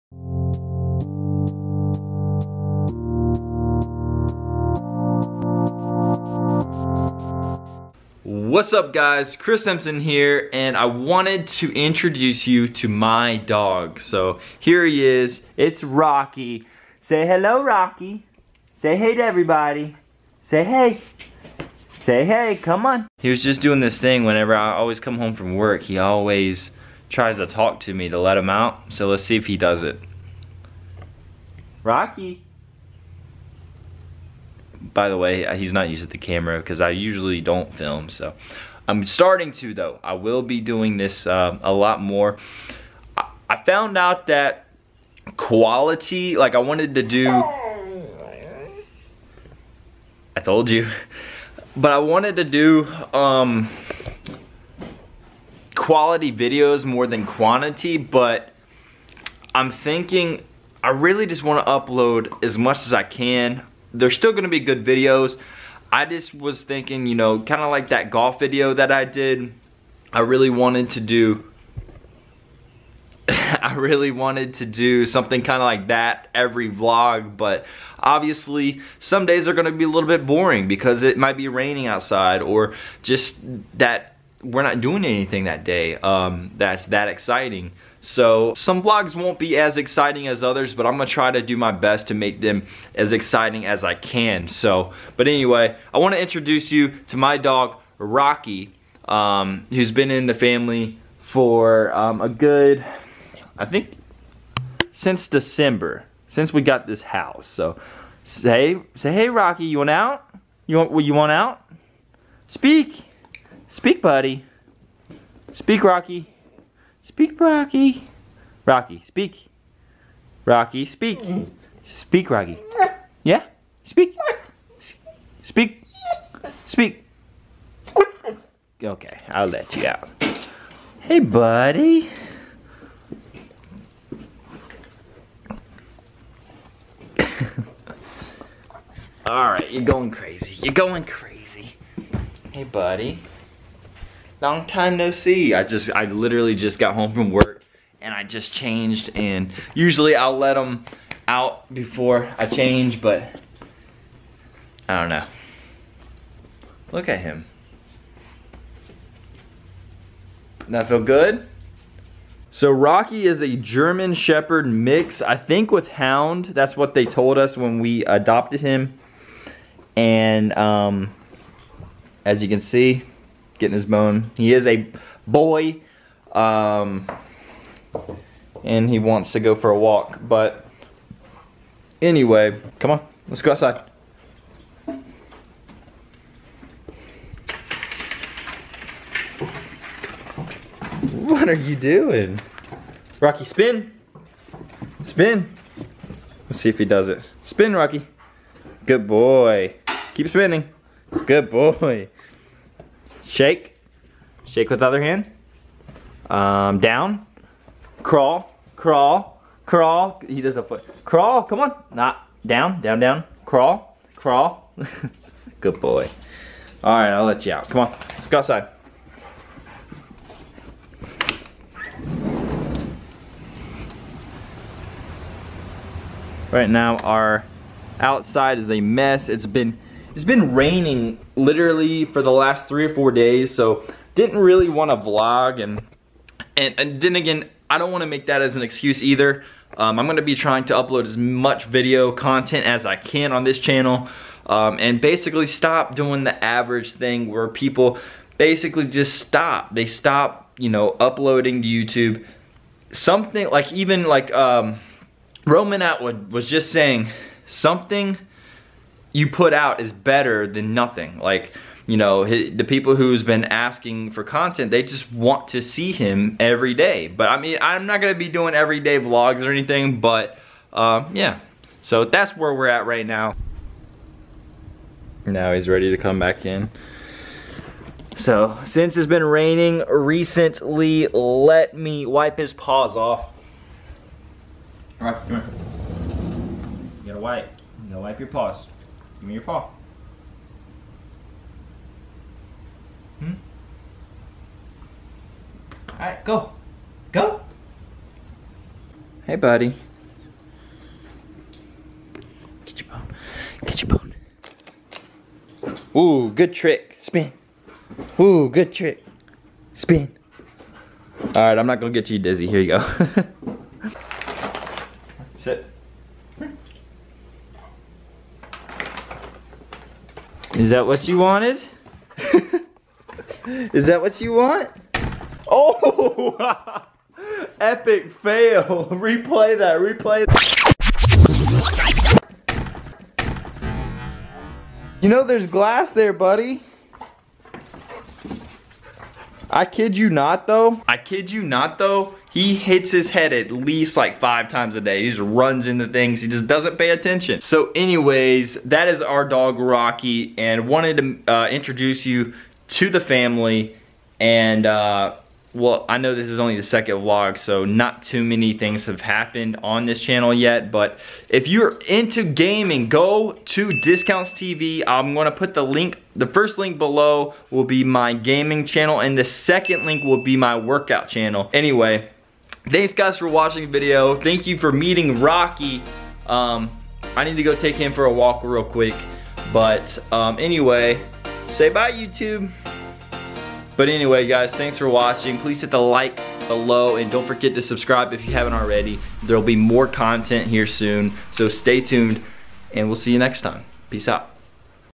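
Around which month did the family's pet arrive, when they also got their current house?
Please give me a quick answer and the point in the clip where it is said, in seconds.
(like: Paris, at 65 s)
December, at 105 s.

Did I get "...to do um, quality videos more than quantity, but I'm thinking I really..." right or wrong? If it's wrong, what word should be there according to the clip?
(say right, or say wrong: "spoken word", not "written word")
right.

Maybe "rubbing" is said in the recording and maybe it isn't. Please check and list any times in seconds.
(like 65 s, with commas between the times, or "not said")
not said.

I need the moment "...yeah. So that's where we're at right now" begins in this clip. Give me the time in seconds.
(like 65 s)
271 s.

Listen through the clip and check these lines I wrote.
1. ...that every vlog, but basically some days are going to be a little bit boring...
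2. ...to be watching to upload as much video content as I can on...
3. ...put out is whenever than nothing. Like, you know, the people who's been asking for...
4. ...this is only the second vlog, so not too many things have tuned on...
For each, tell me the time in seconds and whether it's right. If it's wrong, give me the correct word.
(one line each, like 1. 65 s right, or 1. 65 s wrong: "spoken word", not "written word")
1. 75 s wrong: "obviously", not "basically"
2. 240 s wrong: "trying", not "watching"
3. 259 s wrong: "better", not "whenever"
4. 356 s wrong: "happened", not "tuned".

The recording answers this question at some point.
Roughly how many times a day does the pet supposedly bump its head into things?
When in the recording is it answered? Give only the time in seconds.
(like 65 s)
344 s.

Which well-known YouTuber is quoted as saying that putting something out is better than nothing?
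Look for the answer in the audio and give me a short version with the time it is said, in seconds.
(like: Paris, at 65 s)
Roman Atwood, at 255 s.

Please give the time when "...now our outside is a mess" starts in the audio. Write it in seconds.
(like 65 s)
226 s.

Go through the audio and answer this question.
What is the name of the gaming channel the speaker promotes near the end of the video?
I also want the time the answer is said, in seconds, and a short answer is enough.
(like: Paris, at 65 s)
DiscountzTV, at 363 s.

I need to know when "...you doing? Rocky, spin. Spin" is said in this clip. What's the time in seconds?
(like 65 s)
191 s.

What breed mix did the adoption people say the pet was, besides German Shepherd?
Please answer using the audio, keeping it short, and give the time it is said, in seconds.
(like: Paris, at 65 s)
Hound, at 165 s.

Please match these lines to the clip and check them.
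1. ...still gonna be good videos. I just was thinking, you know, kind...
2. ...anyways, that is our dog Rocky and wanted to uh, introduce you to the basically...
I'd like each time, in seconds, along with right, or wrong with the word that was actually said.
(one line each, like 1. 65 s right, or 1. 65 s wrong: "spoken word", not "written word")
1. 64 s right
2. 347 s wrong: "family", not "basically".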